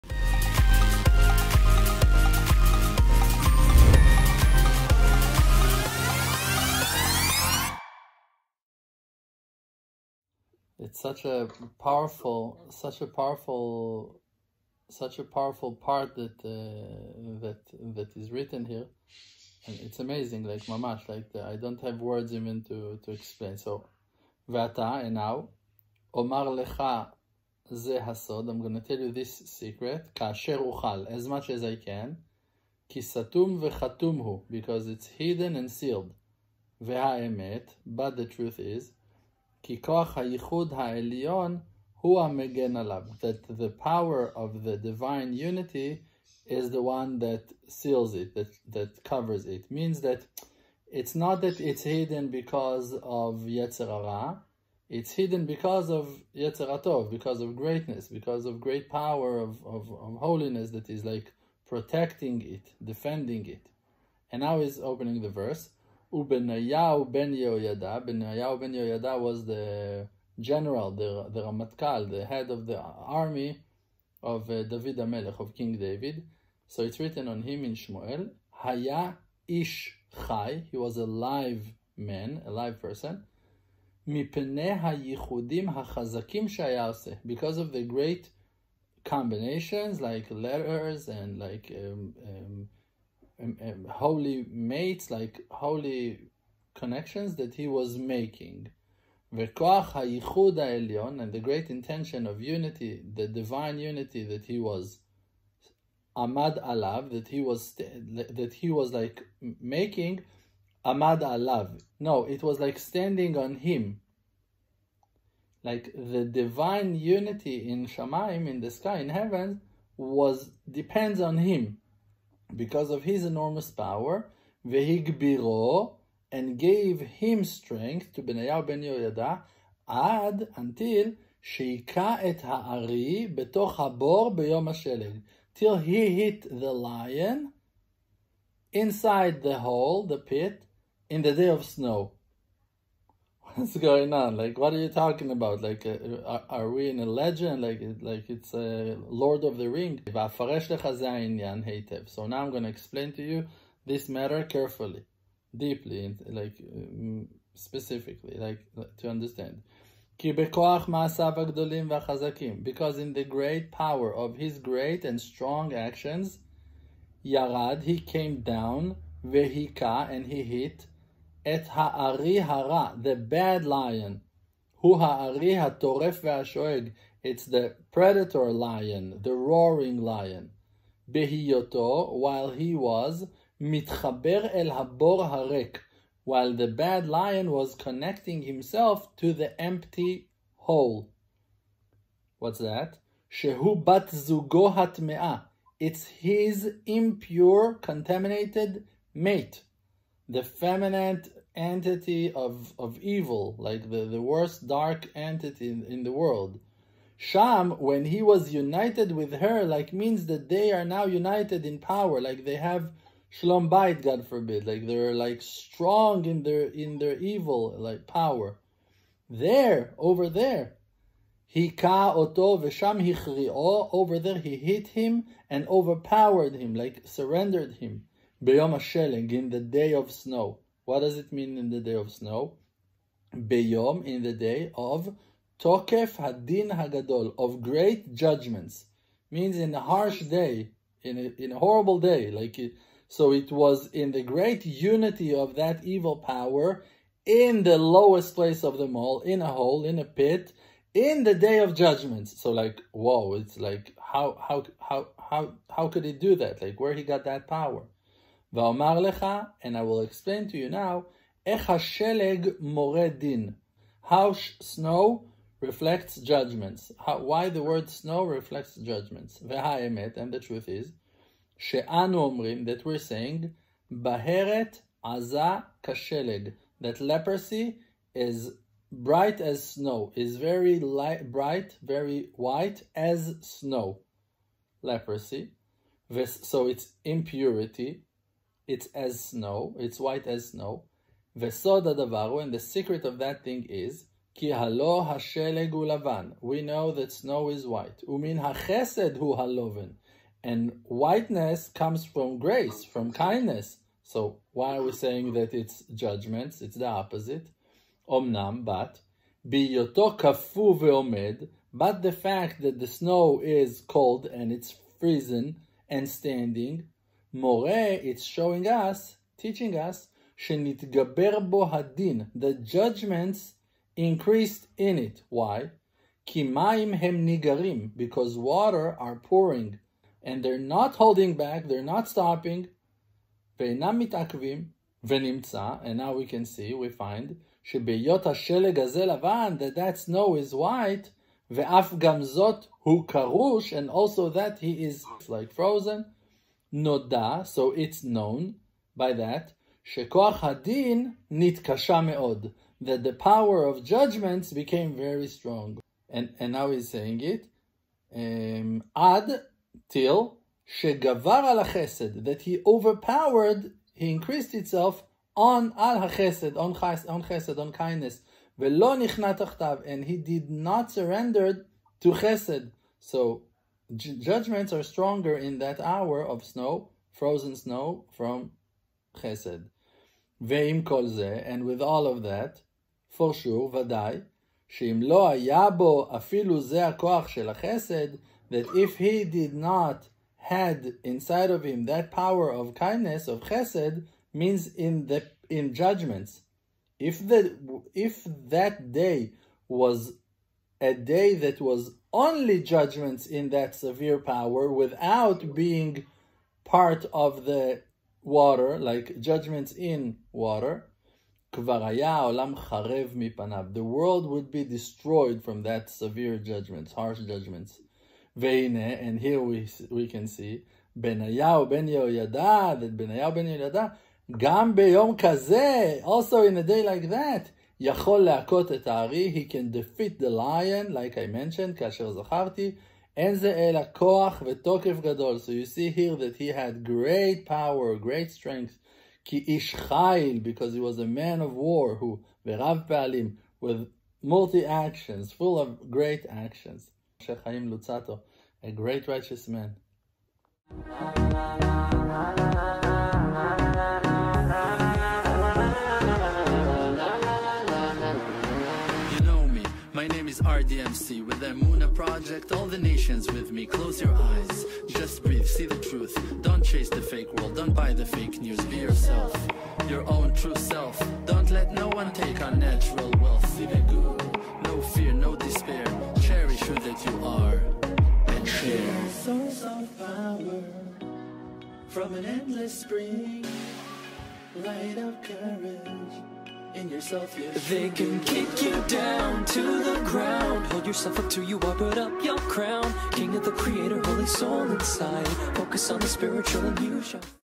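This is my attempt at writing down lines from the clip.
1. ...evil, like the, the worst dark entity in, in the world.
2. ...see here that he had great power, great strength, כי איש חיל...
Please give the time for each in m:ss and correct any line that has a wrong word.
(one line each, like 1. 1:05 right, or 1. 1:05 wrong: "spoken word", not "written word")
1. 3:22 right
2. 7:15 right.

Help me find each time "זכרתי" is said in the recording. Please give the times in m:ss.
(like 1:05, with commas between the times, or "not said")
7:12.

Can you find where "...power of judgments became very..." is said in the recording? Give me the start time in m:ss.
5:53.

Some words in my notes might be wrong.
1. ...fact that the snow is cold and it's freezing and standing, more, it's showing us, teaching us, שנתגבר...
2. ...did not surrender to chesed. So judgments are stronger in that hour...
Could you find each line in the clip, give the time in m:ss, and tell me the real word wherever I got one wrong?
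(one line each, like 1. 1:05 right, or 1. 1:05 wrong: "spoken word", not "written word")
1. 5:12 right
2. 6:10 right.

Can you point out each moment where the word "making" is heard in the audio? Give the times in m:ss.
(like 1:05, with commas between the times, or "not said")
1:37, 1:49.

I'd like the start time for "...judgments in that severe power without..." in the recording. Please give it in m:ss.
6:42.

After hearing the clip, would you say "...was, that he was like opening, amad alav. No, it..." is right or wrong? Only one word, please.
wrong.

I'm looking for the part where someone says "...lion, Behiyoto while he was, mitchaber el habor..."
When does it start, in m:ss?
3:00.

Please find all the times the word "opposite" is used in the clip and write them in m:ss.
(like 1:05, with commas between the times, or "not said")
5:06.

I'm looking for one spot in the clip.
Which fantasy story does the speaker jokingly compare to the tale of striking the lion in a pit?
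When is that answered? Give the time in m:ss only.
2:29.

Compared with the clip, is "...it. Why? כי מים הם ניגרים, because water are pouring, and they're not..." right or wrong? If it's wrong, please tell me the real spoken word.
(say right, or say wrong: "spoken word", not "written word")
right.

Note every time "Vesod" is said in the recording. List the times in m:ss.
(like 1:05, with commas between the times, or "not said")
4:51.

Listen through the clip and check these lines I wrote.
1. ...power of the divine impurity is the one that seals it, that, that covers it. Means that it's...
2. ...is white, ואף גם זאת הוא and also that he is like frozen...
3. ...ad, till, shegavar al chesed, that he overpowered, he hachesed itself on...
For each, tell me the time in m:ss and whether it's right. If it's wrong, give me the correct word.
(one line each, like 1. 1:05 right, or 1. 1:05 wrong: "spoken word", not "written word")
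1. 0:43 wrong: "unity", not "impurity"
2. 5:40 right
3. 5:58 wrong: "increased", not "hachesed".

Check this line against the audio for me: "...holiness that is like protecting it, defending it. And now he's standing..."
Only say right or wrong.
wrong.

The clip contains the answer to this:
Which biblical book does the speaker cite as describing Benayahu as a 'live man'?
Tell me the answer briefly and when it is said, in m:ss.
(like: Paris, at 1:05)
Shmuel, at 1:17.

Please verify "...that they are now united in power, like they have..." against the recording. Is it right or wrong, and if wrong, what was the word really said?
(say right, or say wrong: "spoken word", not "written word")
right.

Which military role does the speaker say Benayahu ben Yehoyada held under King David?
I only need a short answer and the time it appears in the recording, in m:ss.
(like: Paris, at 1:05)
Ramatkal, at 1:11.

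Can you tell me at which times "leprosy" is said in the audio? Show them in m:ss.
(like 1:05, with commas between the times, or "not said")
4:36, 4:44.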